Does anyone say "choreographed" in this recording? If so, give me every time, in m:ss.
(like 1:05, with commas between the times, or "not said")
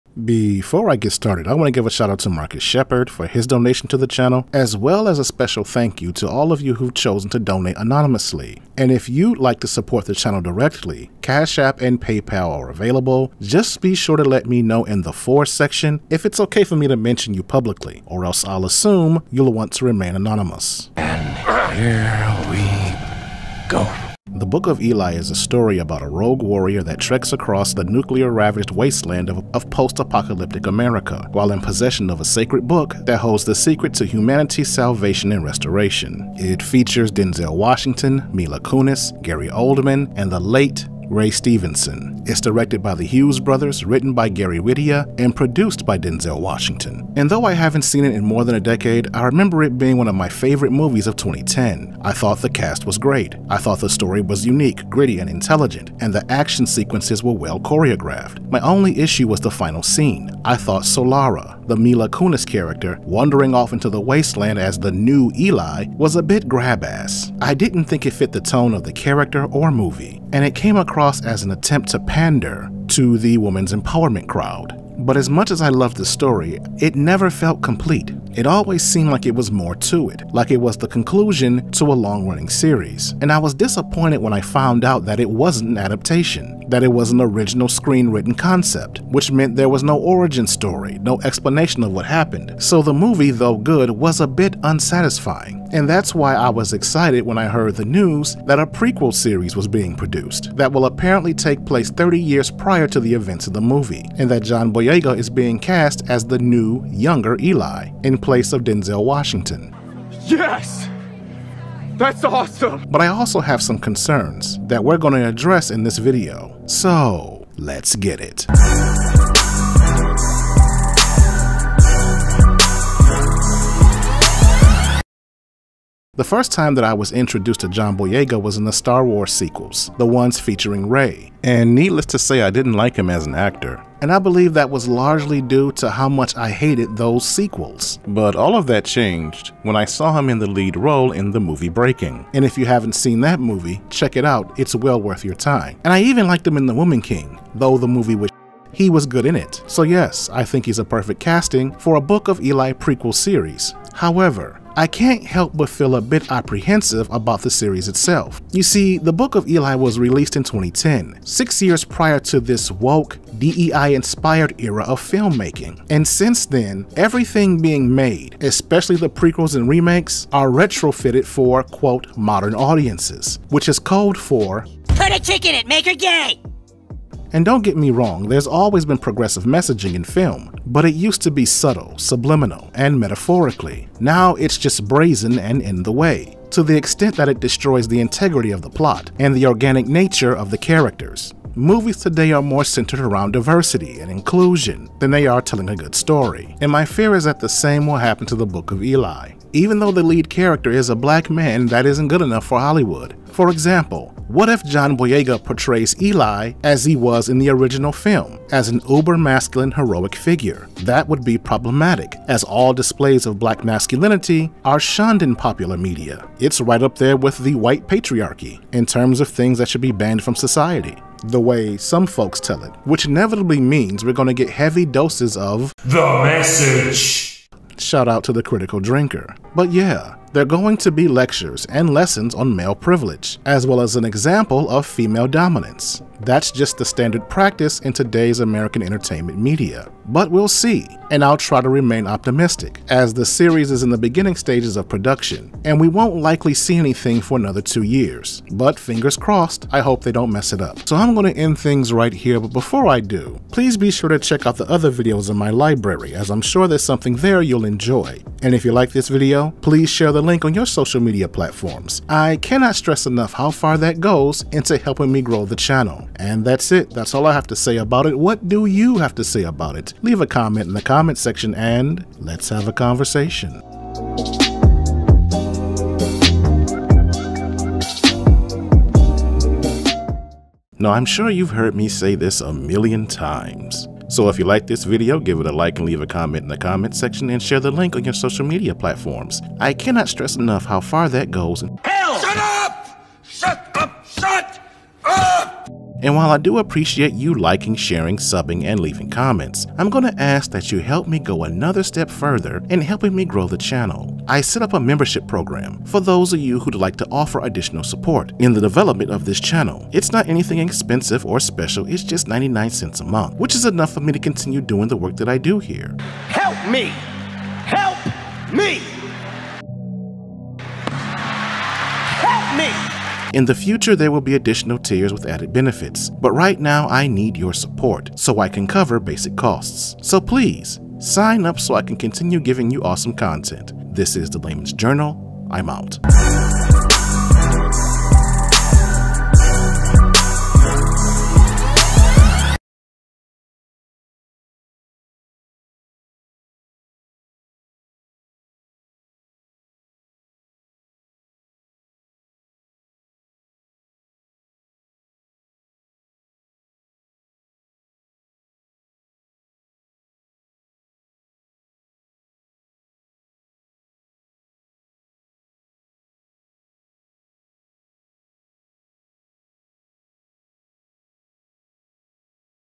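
0:57.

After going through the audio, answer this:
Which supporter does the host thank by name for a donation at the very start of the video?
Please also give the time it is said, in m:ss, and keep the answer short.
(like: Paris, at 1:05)
Marcus Shepard, at 0:02.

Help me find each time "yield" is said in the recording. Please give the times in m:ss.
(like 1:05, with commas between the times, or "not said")
not said.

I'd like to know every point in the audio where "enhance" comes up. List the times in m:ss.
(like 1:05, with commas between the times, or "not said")
not said.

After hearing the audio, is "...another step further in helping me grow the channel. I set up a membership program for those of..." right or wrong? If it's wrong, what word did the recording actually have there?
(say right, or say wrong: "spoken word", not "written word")
right.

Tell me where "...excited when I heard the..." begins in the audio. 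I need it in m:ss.
1:36.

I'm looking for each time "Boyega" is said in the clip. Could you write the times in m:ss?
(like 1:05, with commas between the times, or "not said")
1:44, 2:07, 3:24.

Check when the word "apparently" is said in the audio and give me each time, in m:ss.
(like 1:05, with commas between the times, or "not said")
1:40.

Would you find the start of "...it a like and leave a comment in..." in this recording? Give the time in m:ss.
4:45.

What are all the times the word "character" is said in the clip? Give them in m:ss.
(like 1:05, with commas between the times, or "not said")
1:02, 1:08, 3:10, 3:20.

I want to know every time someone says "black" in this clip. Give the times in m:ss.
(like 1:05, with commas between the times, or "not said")
3:20, 3:33.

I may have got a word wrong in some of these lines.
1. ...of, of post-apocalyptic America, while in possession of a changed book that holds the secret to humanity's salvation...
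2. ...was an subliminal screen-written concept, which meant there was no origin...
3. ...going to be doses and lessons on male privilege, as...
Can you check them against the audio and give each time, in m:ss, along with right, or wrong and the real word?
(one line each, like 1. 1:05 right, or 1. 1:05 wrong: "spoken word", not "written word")
1. 0:29 wrong: "sacred", not "changed"
2. 1:26 wrong: "original", not "subliminal"
3. 3:50 wrong: "lectures", not "doses".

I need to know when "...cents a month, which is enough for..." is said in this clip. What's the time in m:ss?
5:12.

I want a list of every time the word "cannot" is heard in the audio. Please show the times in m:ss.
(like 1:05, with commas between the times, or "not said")
4:22, 4:49.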